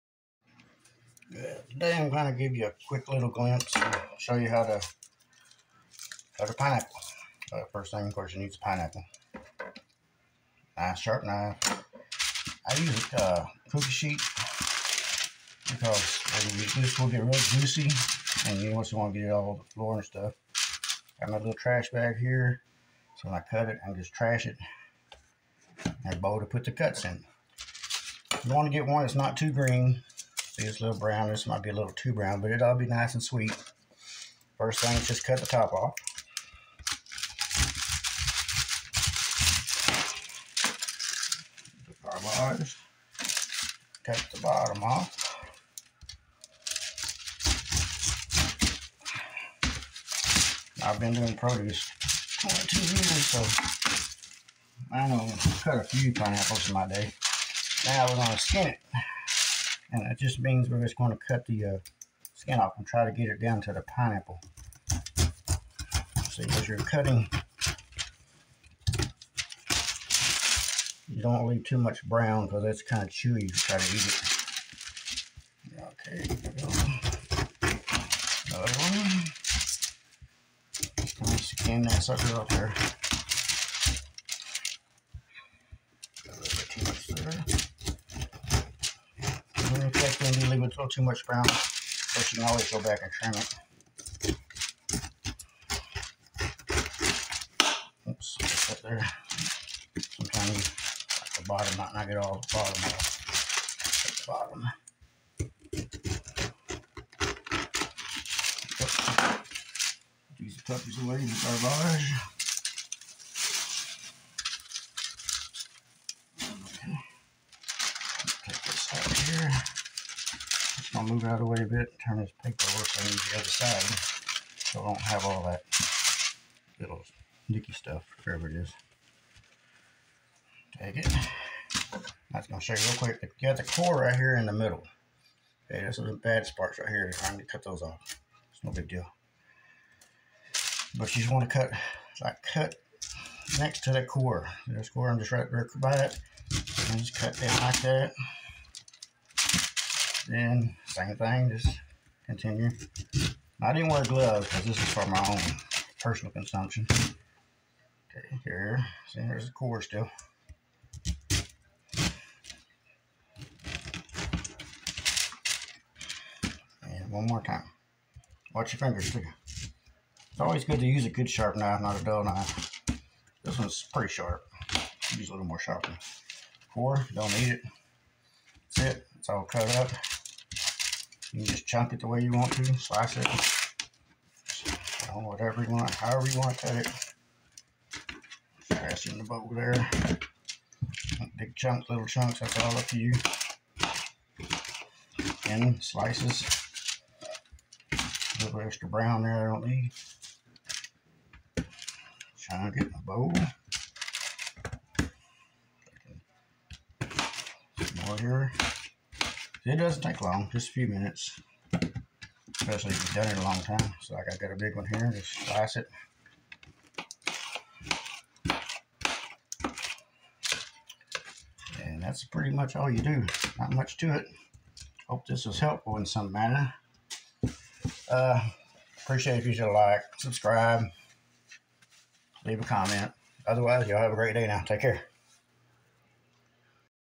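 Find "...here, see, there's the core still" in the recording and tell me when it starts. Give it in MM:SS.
02:38.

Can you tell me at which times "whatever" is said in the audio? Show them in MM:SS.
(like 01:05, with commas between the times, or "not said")
02:08, 03:05.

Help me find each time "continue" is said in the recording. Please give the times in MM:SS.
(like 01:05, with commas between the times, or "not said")
02:32.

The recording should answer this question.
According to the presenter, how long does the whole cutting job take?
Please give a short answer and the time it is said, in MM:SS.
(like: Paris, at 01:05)
A few minutes, at 03:30.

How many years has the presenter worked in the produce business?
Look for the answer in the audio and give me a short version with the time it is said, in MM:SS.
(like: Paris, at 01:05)
22, at 00:52.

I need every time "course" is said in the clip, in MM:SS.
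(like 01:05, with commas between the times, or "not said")
00:08, 01:32.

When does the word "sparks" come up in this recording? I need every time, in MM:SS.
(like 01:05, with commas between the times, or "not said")
02:16.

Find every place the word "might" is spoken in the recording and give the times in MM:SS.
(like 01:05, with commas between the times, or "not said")
00:31, 01:41.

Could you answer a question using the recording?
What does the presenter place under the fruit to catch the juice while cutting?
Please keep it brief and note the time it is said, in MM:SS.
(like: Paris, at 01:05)
Cookie sheet, at 00:13.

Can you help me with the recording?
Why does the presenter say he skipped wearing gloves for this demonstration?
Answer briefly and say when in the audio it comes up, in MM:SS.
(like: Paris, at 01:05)
Personal consumption, at 02:35.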